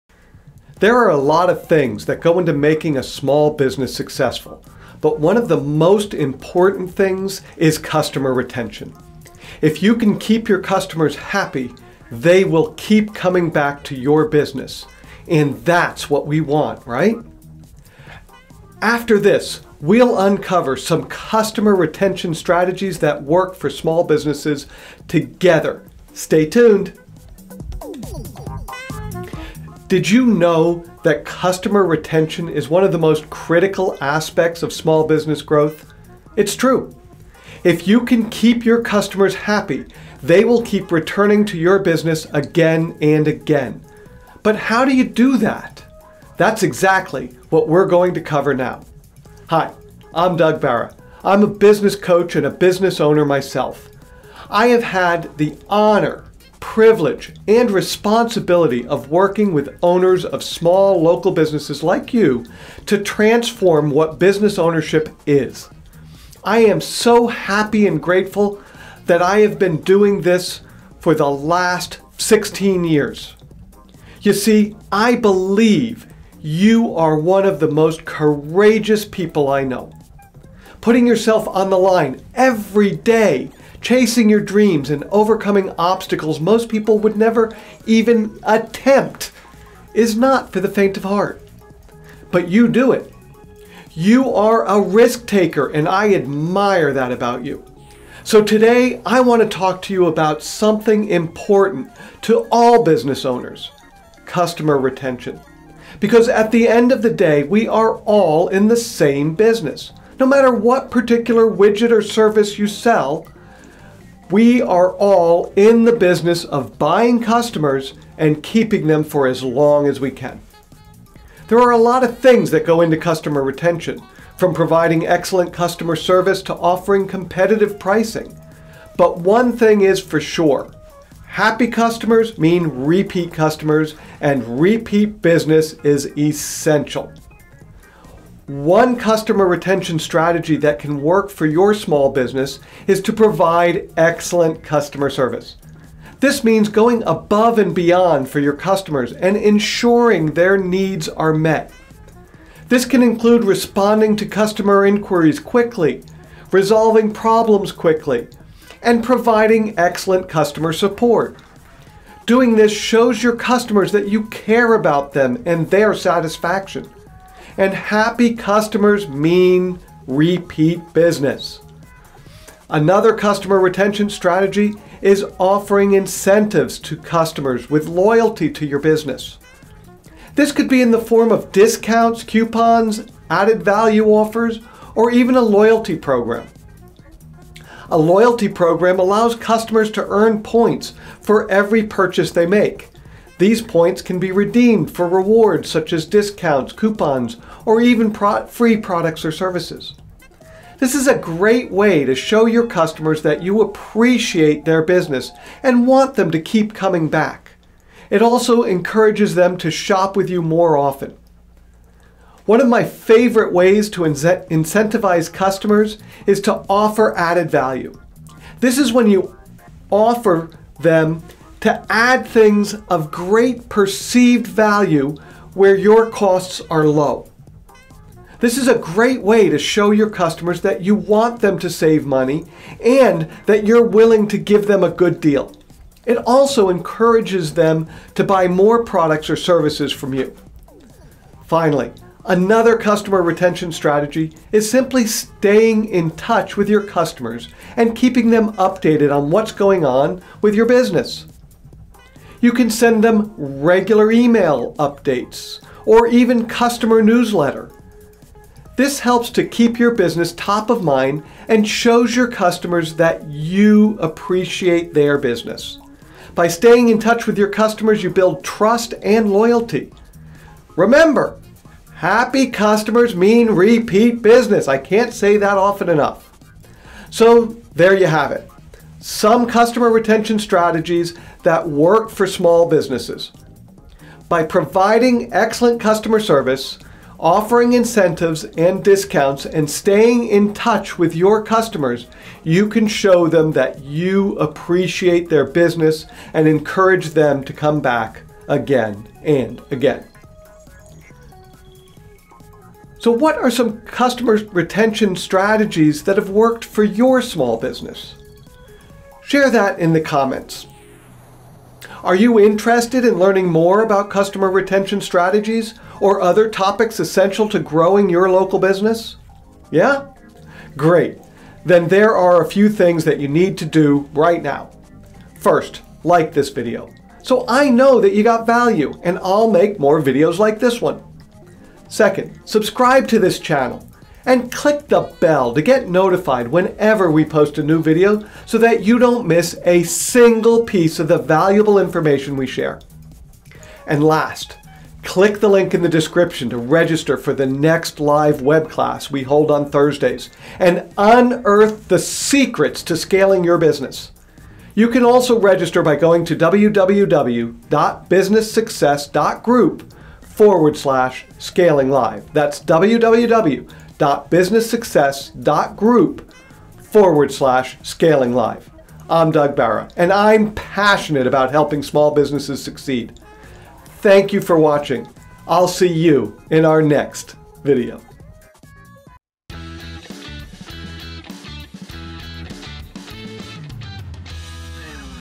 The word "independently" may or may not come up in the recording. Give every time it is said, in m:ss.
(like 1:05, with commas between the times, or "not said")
not said.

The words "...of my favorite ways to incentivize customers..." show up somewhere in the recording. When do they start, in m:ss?
3:32.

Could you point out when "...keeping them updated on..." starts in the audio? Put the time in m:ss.
4:07.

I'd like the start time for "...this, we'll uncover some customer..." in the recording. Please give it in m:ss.
0:19.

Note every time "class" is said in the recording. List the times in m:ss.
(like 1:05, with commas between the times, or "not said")
5:48.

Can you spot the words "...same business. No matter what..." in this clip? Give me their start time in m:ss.
1:48.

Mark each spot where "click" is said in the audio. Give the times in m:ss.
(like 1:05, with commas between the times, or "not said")
5:34, 5:45.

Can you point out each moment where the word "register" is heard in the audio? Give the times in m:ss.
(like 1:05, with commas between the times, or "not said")
5:46, 5:55.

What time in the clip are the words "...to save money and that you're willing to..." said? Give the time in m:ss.
3:51.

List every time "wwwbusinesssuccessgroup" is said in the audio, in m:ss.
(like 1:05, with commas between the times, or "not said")
5:56, 6:04.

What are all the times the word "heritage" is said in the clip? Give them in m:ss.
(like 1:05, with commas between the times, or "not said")
not said.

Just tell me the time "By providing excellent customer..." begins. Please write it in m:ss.
4:44.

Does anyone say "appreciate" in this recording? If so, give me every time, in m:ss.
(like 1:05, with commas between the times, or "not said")
3:23, 4:23, 4:54.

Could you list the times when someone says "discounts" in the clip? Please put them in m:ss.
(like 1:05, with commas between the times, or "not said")
3:01, 3:16, 4:48.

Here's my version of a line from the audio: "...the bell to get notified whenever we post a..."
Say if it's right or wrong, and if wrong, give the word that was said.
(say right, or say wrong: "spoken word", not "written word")
right.